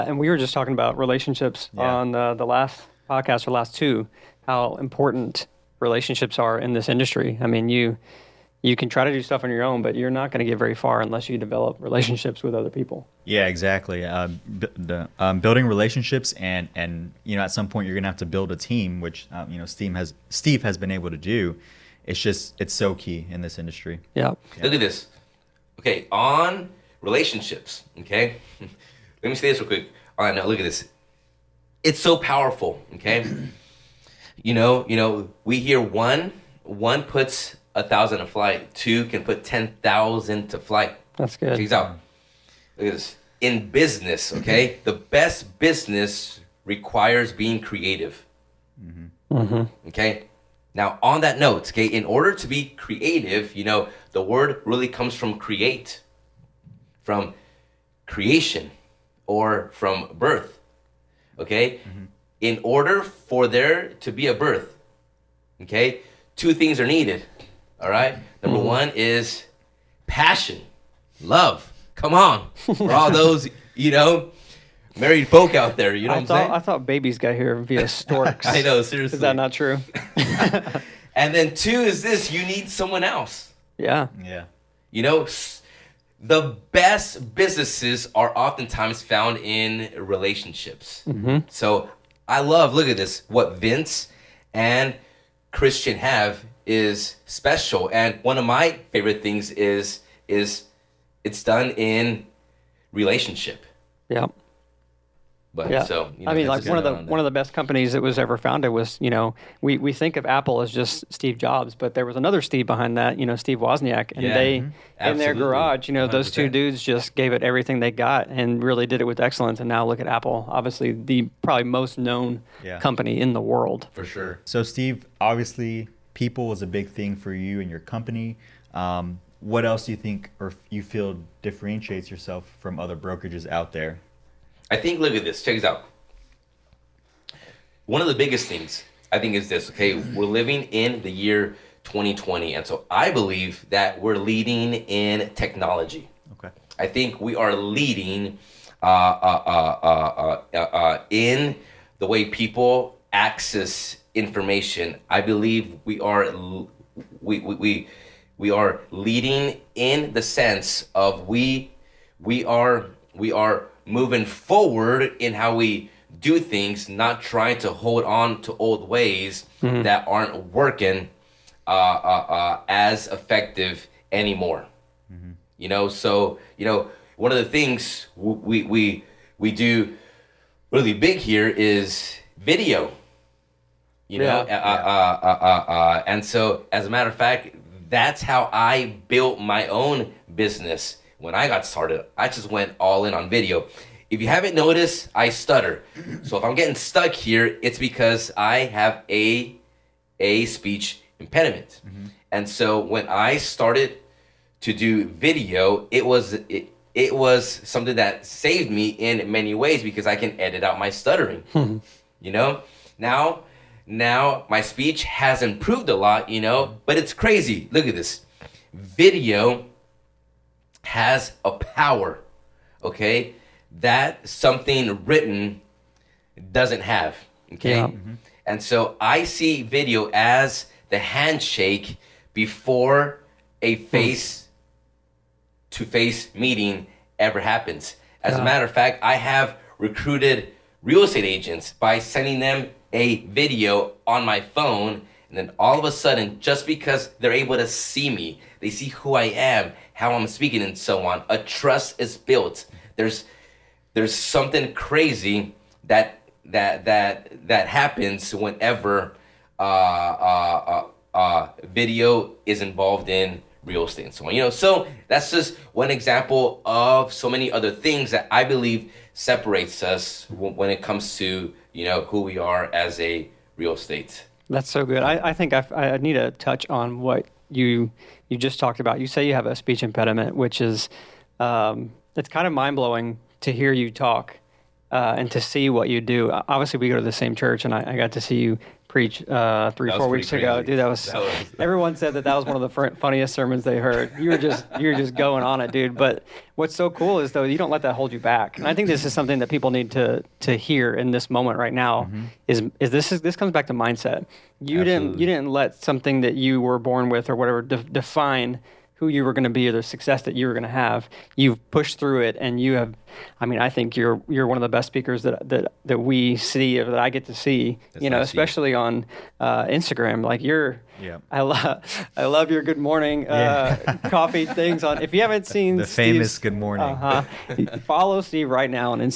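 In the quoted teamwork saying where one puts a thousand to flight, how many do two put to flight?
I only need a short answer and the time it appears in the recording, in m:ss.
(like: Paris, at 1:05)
10,000, at 0:39.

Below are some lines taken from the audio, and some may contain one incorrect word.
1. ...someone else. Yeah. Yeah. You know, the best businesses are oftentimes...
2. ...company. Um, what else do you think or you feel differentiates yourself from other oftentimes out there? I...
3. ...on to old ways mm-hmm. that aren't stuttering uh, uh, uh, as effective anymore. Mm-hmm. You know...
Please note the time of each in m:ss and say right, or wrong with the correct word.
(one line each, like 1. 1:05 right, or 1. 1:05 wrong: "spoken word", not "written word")
1. 1:22 right
2. 2:07 wrong: "brokerages", not "oftentimes"
3. 2:48 wrong: "working", not "stuttering".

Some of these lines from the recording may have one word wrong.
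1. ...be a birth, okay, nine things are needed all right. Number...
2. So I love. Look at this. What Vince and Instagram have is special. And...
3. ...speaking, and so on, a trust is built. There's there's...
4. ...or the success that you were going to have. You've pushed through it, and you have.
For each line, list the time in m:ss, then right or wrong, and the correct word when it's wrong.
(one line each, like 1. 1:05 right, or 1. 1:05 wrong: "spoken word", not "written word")
1. 1:04 wrong: "two", not "nine"
2. 1:31 wrong: "Christian", not "Instagram"
3. 4:10 right
4. 5:09 right.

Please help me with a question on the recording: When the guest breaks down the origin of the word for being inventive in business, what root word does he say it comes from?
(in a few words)
create.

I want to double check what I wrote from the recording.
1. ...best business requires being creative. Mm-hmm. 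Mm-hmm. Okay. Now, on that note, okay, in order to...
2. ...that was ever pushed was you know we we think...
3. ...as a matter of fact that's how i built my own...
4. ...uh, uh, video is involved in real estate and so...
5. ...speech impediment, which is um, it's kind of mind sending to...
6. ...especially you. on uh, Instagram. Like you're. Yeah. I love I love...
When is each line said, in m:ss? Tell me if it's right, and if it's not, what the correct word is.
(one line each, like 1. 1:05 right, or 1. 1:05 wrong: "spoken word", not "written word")
1. 0:44 right
2. 1:47 wrong: "founded", not "pushed"
3. 3:06 right
4. 4:21 right
5. 4:39 wrong: "blowing", not "sending"
6. 5:18 right.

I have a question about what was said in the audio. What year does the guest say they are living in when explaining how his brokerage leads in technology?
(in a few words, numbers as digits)
2020.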